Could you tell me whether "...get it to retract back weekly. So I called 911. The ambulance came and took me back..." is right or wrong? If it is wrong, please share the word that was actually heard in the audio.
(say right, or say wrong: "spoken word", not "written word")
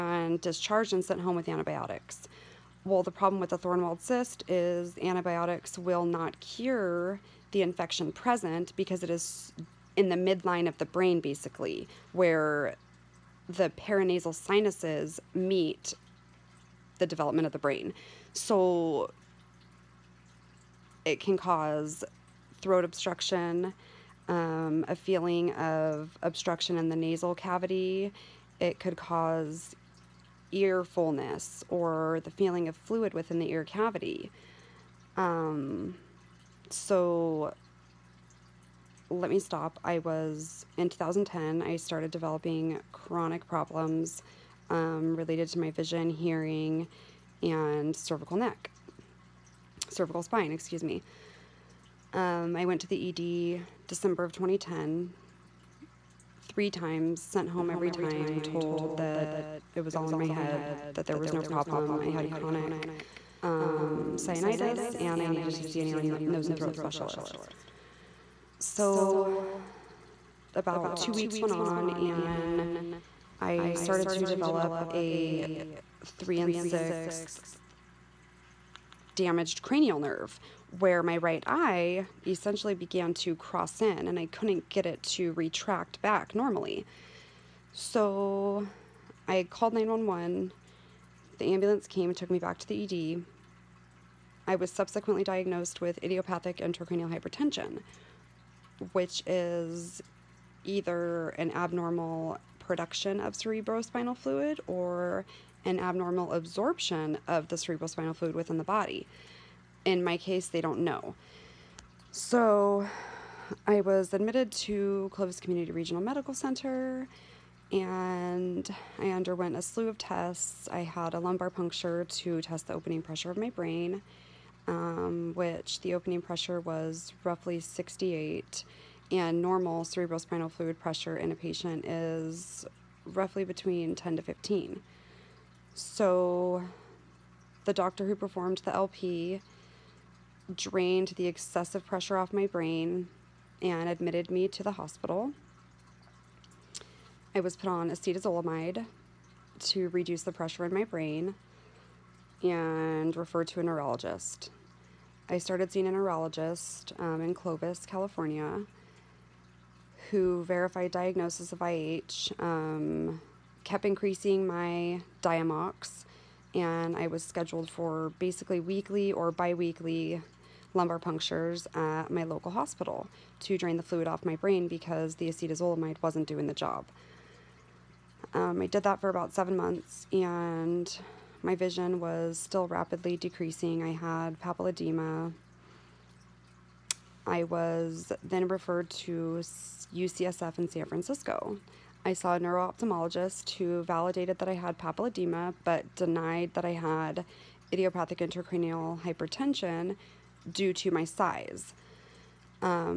wrong: "normally", not "weekly".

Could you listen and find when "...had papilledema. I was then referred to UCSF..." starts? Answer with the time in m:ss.
3:03.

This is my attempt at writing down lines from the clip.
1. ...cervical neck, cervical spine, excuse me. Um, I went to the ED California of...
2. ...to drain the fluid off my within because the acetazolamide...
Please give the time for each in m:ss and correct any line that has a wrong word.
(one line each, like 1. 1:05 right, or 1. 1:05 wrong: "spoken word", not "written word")
1. 0:47 wrong: "December", not "California"
2. 2:53 wrong: "brain", not "within".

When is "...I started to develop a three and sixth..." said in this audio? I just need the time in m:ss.
1:13.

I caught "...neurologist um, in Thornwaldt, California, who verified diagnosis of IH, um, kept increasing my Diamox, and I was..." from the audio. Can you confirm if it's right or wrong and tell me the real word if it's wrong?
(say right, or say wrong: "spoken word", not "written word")
wrong: "Clovis", not "Thornwaldt".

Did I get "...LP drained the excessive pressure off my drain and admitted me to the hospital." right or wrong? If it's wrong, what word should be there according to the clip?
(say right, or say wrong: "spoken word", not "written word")
wrong: "brain", not "drain".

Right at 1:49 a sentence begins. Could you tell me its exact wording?
In my case, they don't know.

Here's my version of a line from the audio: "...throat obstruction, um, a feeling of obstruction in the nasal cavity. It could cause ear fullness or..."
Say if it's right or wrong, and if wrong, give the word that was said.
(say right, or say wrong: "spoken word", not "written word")
right.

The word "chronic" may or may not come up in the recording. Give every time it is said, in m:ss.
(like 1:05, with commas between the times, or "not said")
0:42, 1:02.